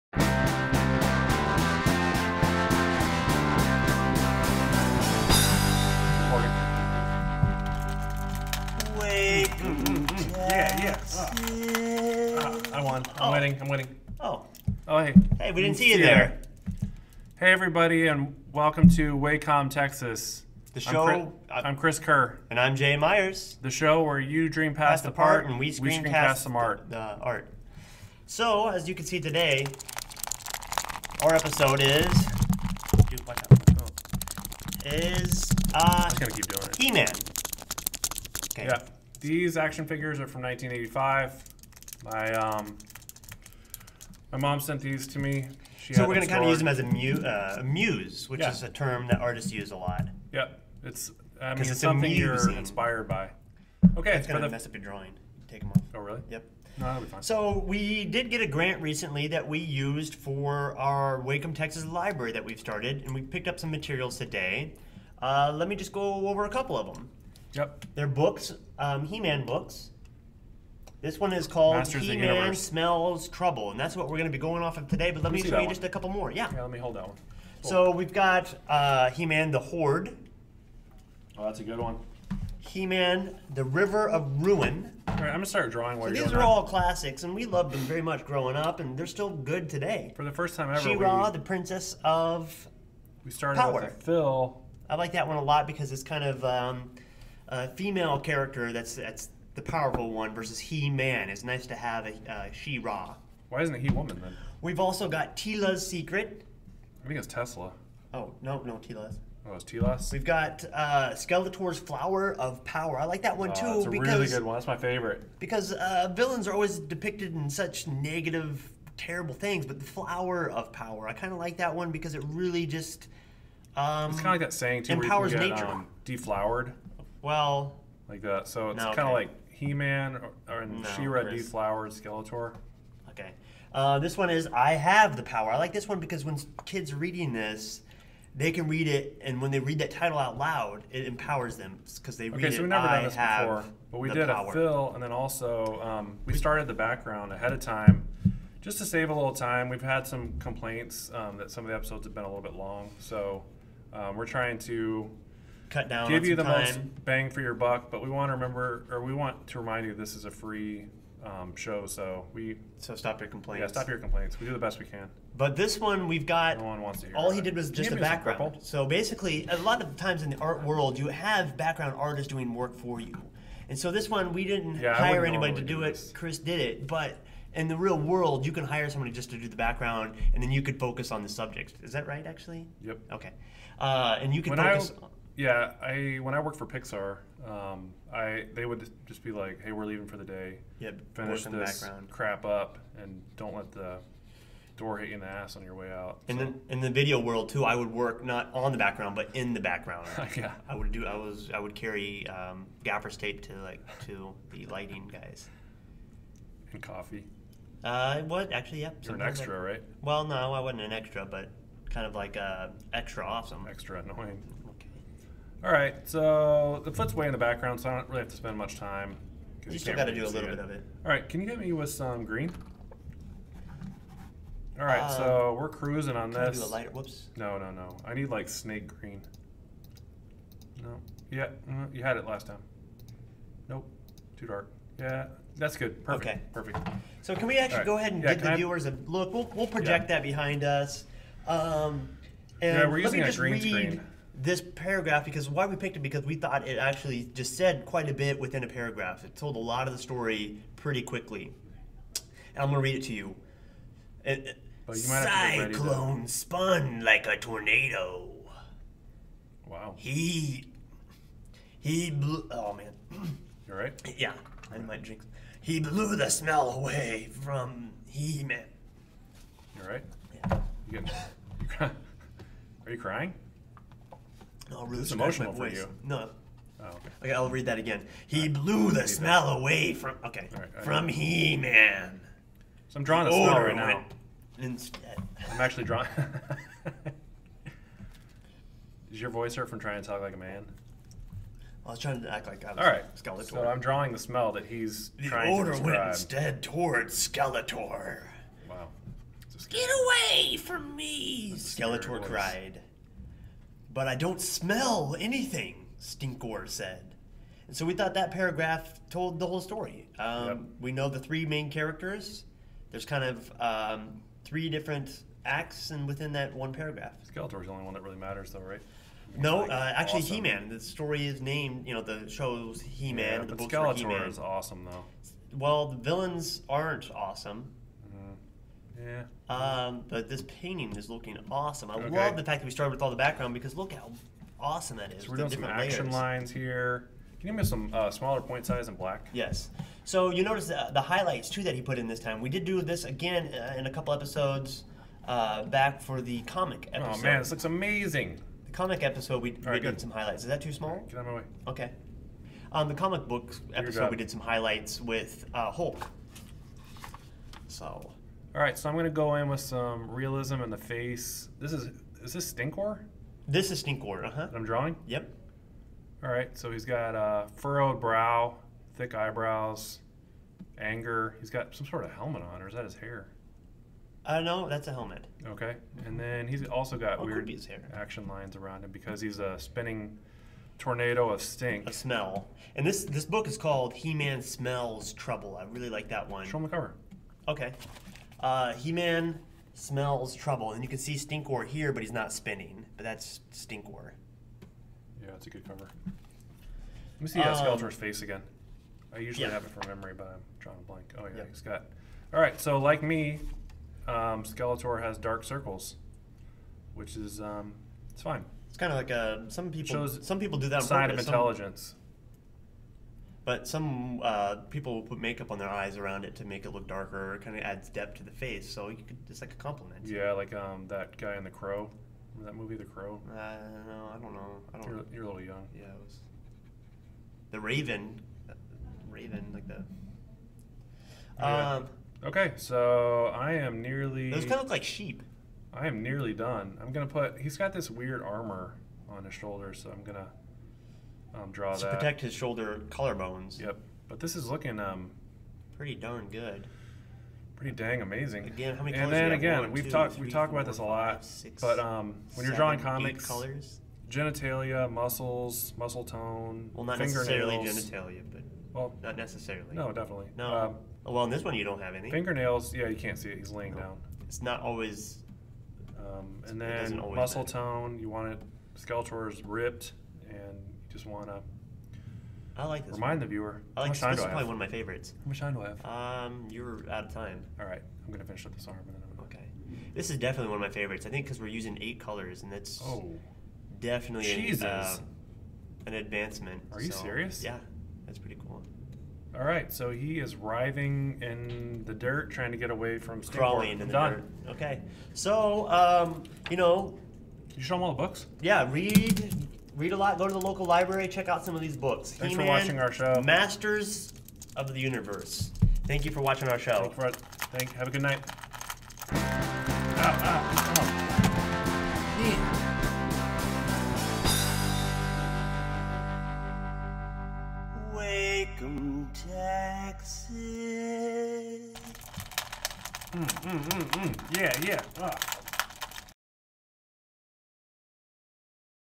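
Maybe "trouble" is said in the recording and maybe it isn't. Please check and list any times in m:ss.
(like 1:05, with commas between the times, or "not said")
1:13, 6:25, 6:30.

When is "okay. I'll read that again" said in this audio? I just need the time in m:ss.
4:37.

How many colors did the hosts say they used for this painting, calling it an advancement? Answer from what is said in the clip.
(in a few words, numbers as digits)
8.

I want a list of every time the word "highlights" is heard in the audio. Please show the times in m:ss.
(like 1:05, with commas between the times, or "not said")
5:41, 5:50, 5:54.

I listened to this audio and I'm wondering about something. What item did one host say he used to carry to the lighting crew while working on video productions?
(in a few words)
Gaffers tape.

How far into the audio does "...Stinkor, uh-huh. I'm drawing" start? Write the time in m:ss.
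6:03.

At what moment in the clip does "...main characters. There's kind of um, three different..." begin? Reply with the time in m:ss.
5:11.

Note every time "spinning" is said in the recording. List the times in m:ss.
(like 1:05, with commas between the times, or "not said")
6:19, 6:32.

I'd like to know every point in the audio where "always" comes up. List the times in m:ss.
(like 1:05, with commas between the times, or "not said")
1:56, 7:44.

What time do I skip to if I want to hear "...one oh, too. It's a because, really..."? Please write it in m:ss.
1:53.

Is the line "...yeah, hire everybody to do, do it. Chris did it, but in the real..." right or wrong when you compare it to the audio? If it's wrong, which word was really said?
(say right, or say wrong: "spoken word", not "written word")
wrong: "anybody", not "everybody".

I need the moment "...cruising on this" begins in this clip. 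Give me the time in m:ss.
3:45.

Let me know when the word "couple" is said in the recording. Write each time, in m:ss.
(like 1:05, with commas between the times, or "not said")
1:06, 1:15, 5:43.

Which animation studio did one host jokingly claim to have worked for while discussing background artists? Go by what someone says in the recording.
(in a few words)
Pixar.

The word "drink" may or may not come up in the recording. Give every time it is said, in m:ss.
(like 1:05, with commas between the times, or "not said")
4:25.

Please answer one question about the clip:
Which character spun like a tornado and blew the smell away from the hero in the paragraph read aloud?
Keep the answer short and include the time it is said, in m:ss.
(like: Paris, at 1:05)
Cyclone, at 4:14.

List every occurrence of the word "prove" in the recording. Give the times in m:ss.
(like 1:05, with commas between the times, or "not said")
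not said.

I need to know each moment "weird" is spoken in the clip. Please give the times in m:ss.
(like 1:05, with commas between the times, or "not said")
6:17, 7:17.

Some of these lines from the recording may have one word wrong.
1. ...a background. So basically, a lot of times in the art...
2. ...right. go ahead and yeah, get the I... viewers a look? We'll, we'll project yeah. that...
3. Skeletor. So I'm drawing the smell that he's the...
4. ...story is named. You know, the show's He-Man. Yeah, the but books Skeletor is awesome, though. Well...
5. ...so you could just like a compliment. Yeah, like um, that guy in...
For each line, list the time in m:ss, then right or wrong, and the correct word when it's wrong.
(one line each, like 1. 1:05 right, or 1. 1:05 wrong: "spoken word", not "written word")
1. 2:47 right
2. 3:57 right
3. 4:53 right
4. 5:20 right
5. 6:58 right.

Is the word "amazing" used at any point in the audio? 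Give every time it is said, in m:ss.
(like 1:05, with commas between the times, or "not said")
5:47, 7:28.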